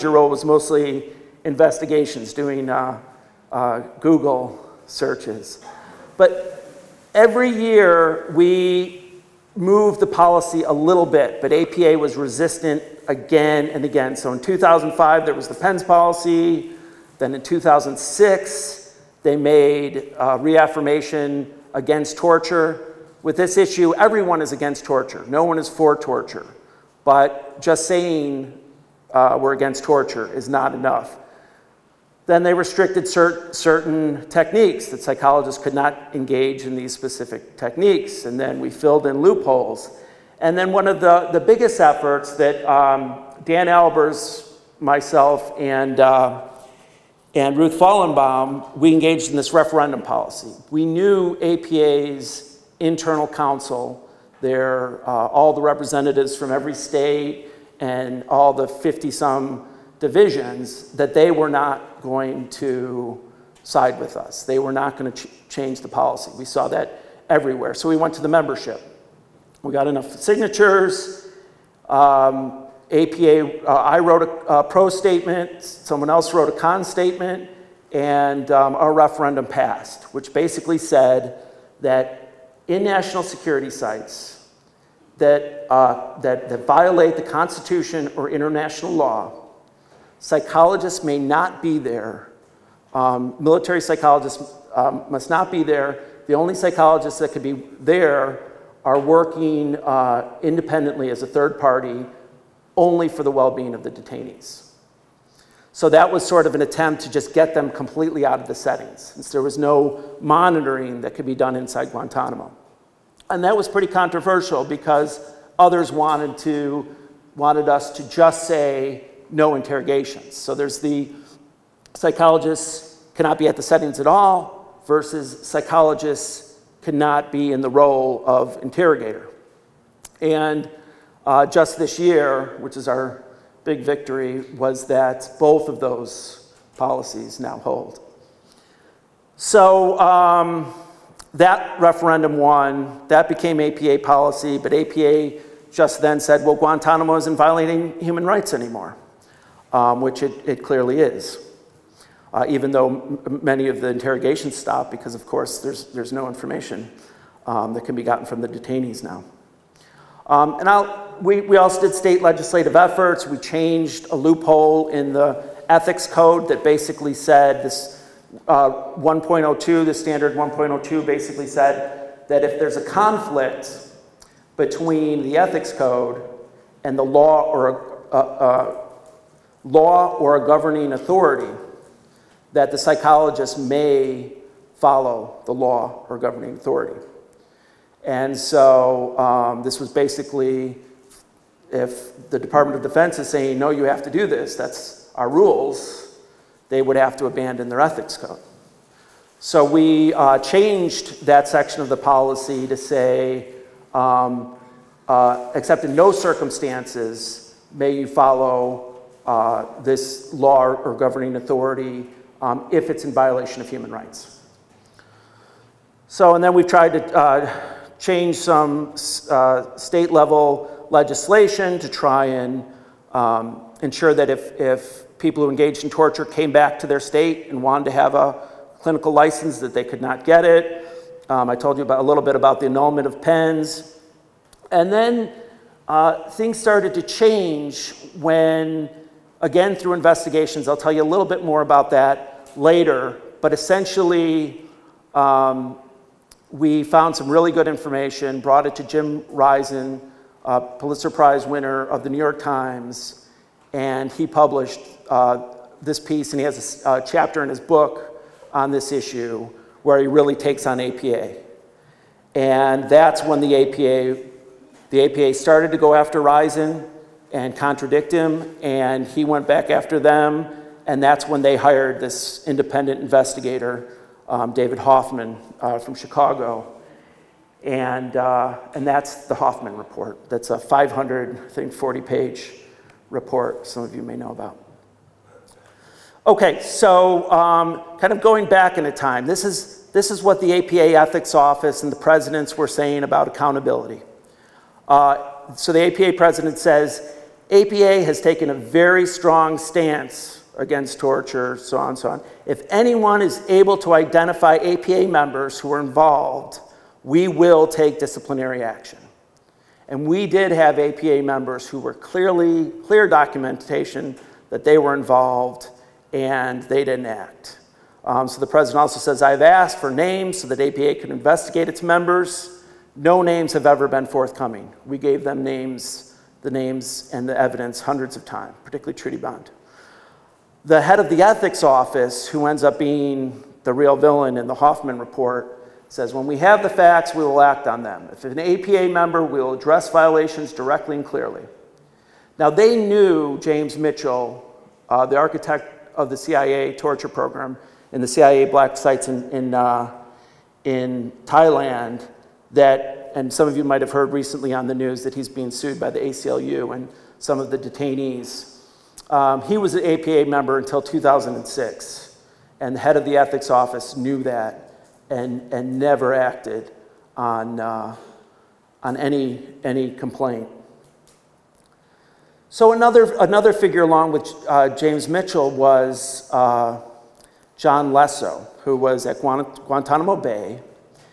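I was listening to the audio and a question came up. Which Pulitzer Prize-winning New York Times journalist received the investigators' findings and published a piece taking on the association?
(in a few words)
Jim Risen.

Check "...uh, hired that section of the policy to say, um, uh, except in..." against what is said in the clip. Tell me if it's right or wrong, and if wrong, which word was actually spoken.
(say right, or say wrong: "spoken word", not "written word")
wrong: "changed", not "hired".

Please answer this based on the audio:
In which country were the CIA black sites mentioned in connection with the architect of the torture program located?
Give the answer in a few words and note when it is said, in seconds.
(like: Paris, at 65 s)
Thailand, at 351 s.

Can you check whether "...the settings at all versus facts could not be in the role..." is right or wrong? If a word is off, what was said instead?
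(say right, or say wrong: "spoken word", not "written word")
wrong: "psychologists", not "facts".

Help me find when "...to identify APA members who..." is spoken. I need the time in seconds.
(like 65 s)
303 s.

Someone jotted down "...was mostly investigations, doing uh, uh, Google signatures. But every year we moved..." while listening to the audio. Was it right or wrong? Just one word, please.
wrong.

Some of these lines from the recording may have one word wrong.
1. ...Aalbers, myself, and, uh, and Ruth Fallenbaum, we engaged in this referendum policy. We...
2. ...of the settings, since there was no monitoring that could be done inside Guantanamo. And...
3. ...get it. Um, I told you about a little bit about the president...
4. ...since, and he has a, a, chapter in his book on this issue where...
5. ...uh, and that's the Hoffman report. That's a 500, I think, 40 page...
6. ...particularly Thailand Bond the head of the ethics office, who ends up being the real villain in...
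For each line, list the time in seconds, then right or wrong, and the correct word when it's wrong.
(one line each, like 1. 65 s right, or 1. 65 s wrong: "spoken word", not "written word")
1. 43 s right
2. 108 s right
3. 230 s wrong: "annulment", not "president"
4. 256 s wrong: "piece", not "since"
5. 278 s right
6. 328 s wrong: "Trudy", not "Thailand".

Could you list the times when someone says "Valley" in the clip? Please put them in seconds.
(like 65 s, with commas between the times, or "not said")
not said.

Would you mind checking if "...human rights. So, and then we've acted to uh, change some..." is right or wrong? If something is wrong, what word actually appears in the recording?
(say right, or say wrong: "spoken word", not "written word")
wrong: "tried", not "acted".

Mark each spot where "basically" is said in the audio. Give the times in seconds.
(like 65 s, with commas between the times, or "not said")
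80 s, 166 s, 171 s, 189 s.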